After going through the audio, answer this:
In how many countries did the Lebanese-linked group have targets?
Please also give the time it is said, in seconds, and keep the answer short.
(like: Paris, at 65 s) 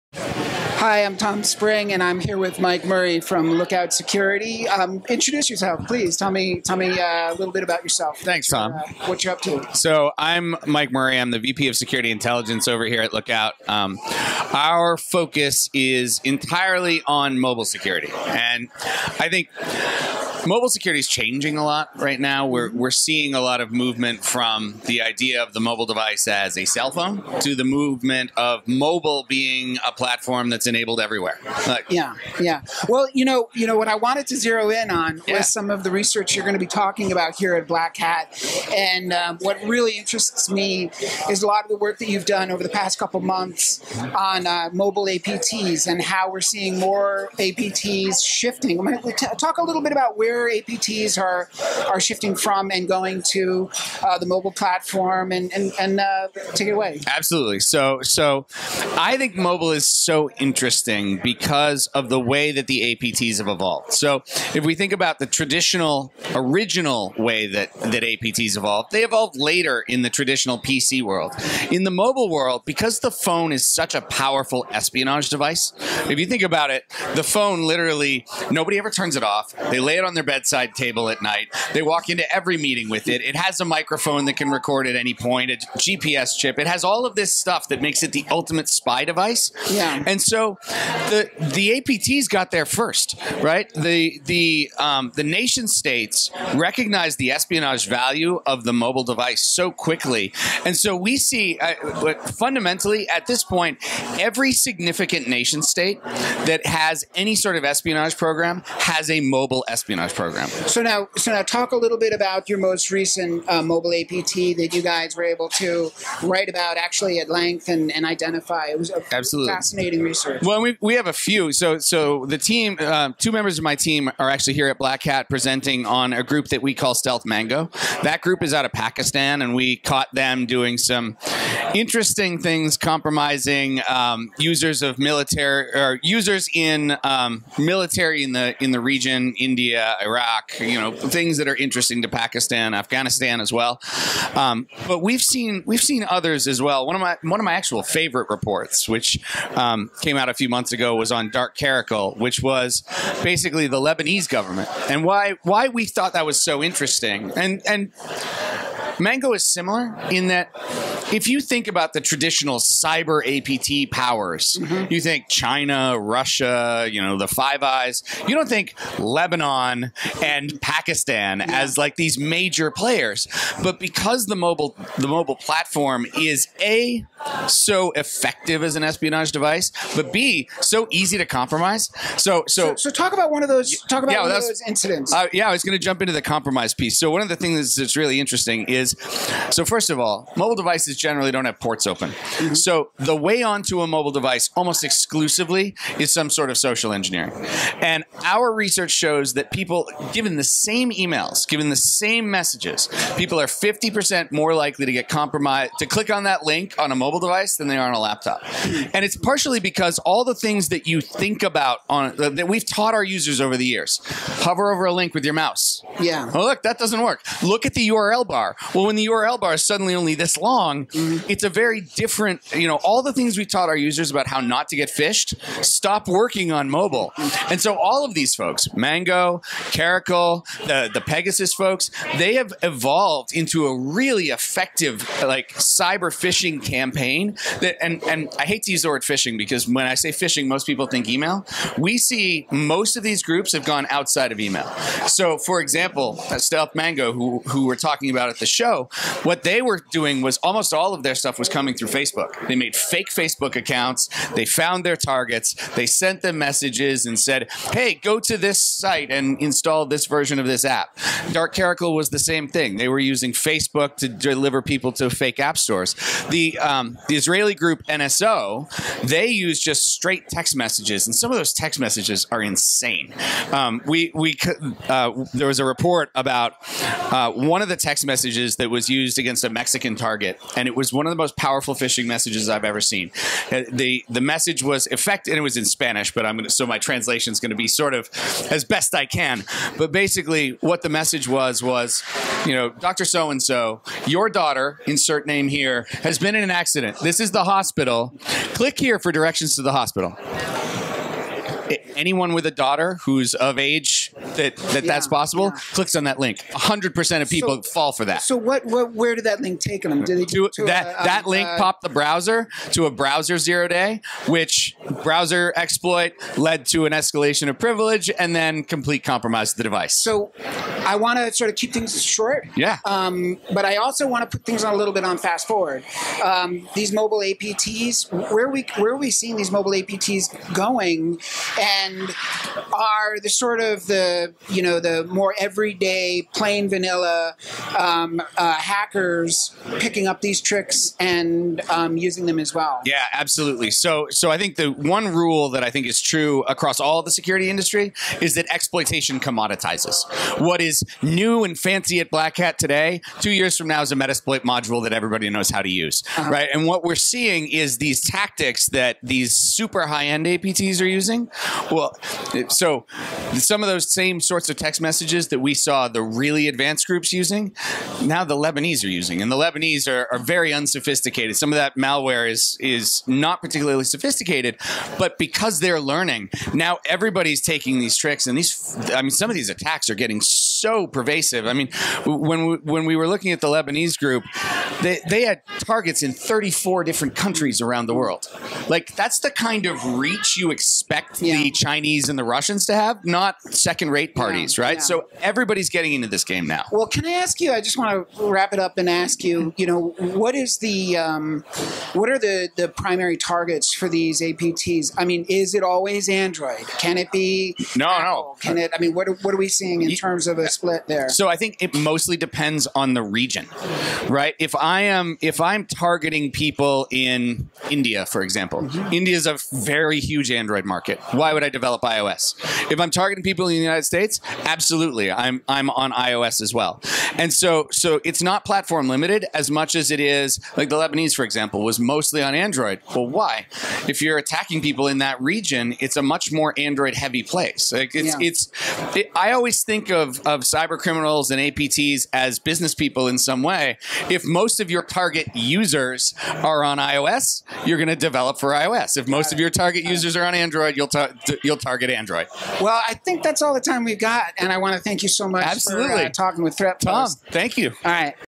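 34, at 386 s.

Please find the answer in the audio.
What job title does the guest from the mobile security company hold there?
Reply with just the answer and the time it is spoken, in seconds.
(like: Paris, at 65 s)
VP of Security Intelligence, at 11 s.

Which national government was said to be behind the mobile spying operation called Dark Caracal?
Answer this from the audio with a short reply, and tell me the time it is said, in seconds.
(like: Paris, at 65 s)
Lebanese government, at 153 s.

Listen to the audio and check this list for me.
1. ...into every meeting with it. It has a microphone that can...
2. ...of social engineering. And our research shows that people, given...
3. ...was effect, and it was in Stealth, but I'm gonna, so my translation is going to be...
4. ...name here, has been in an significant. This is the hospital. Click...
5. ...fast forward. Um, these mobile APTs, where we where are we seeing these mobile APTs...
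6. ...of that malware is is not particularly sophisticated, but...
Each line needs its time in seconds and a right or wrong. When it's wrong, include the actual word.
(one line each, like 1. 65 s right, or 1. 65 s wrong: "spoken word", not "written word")
1. 82 s right
2. 196 s right
3. 284 s wrong: "Spanish", not "Stealth"
4. 295 s wrong: "accident", not "significant"
5. 325 s right
6. 371 s right.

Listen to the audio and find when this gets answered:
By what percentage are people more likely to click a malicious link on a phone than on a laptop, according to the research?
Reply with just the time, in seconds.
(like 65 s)
203 s.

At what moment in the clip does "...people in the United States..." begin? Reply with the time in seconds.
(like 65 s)
423 s.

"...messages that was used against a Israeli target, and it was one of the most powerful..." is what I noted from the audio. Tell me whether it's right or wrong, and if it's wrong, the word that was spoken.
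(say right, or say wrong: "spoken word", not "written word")
wrong: "Mexican", not "Israeli".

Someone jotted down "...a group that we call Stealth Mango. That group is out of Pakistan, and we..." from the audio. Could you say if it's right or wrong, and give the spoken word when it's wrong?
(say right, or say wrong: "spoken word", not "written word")
right.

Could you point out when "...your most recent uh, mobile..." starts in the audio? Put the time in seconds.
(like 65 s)
112 s.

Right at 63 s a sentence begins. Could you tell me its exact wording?
So if we think about the traditional original way that that APTs evolved, they evolved later in the traditional PC world.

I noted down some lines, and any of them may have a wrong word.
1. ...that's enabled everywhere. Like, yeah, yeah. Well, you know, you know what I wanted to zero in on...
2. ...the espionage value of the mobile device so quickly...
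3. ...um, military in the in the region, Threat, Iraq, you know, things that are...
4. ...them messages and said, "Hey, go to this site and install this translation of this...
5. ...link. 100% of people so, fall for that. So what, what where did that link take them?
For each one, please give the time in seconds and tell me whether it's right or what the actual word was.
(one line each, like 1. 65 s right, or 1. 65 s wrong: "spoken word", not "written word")
1. 30 s right
2. 97 s right
3. 137 s wrong: "India", not "Threat"
4. 256 s wrong: "version", not "translation"
5. 306 s right.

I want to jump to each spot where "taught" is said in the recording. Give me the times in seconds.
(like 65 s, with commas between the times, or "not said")
212 s, 223 s.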